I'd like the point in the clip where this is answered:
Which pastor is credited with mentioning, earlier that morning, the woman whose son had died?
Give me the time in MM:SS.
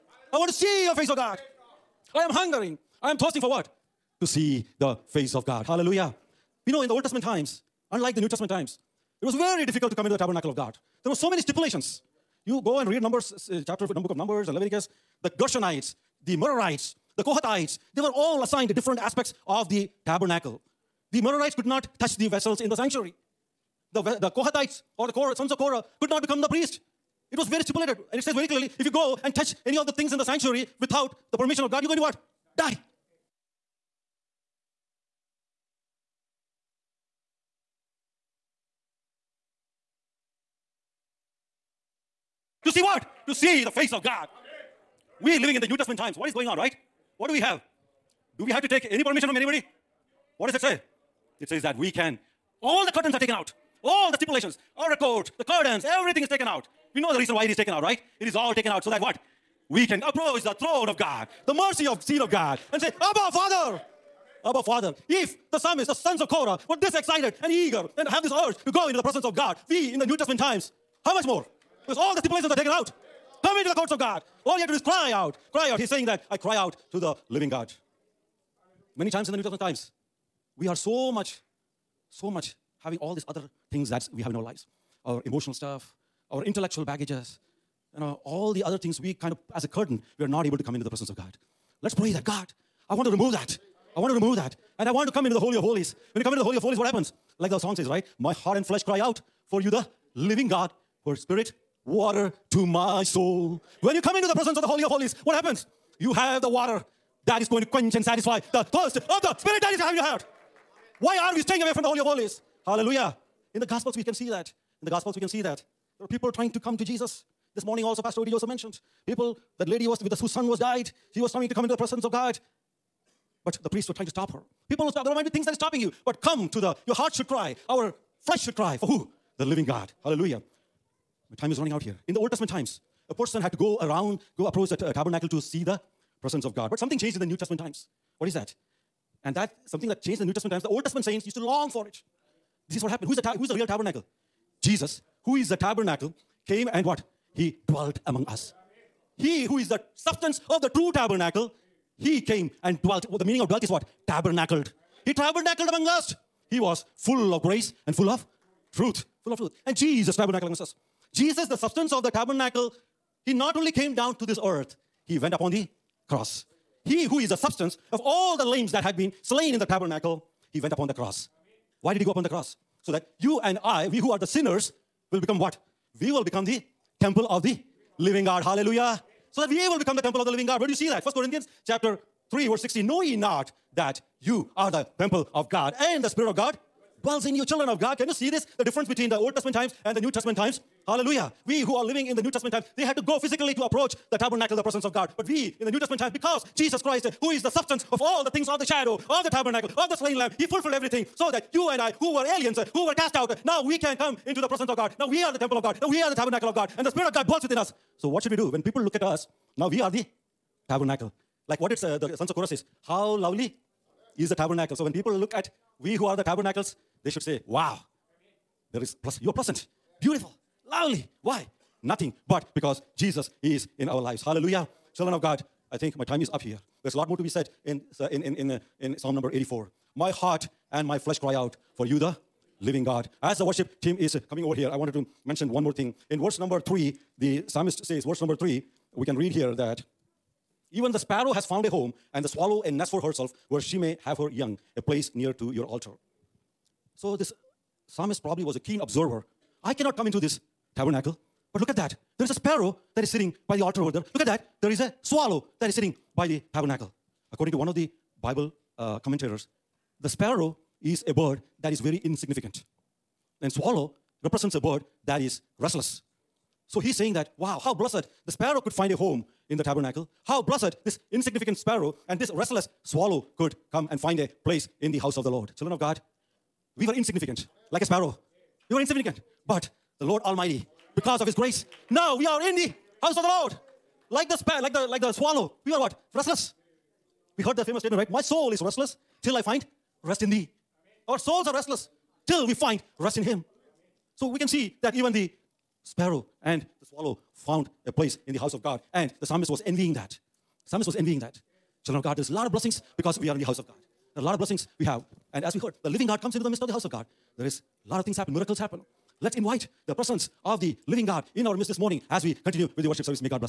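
01:58.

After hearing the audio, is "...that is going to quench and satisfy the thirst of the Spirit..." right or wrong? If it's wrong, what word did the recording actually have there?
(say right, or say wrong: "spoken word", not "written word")
right.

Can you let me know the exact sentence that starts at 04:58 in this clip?
And the psalmist was envying that.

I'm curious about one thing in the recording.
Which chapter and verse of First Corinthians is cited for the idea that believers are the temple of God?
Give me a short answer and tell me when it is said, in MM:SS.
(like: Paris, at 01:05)
Chapter 3, verse 16, at 03:02.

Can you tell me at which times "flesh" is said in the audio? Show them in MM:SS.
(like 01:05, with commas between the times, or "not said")
01:38, 02:08, 03:50.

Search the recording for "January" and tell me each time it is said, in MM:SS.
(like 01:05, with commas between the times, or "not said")
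not said.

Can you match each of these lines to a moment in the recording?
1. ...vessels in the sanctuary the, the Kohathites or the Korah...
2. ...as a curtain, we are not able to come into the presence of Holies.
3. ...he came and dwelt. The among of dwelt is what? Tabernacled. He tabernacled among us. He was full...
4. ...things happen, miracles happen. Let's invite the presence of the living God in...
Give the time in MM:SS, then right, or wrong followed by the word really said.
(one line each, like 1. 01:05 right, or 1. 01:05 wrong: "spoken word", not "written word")
1. 00:22 right
2. 01:29 wrong: "God", not "Holies"
3. 02:31 wrong: "meaning", not "among"
4. 05:08 right.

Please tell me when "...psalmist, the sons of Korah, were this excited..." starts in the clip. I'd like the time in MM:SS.
01:05.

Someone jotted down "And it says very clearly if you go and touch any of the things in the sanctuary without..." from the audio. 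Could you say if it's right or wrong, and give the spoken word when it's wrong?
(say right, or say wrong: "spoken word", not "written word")
right.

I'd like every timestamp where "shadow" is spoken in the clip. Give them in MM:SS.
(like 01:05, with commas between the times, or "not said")
03:18.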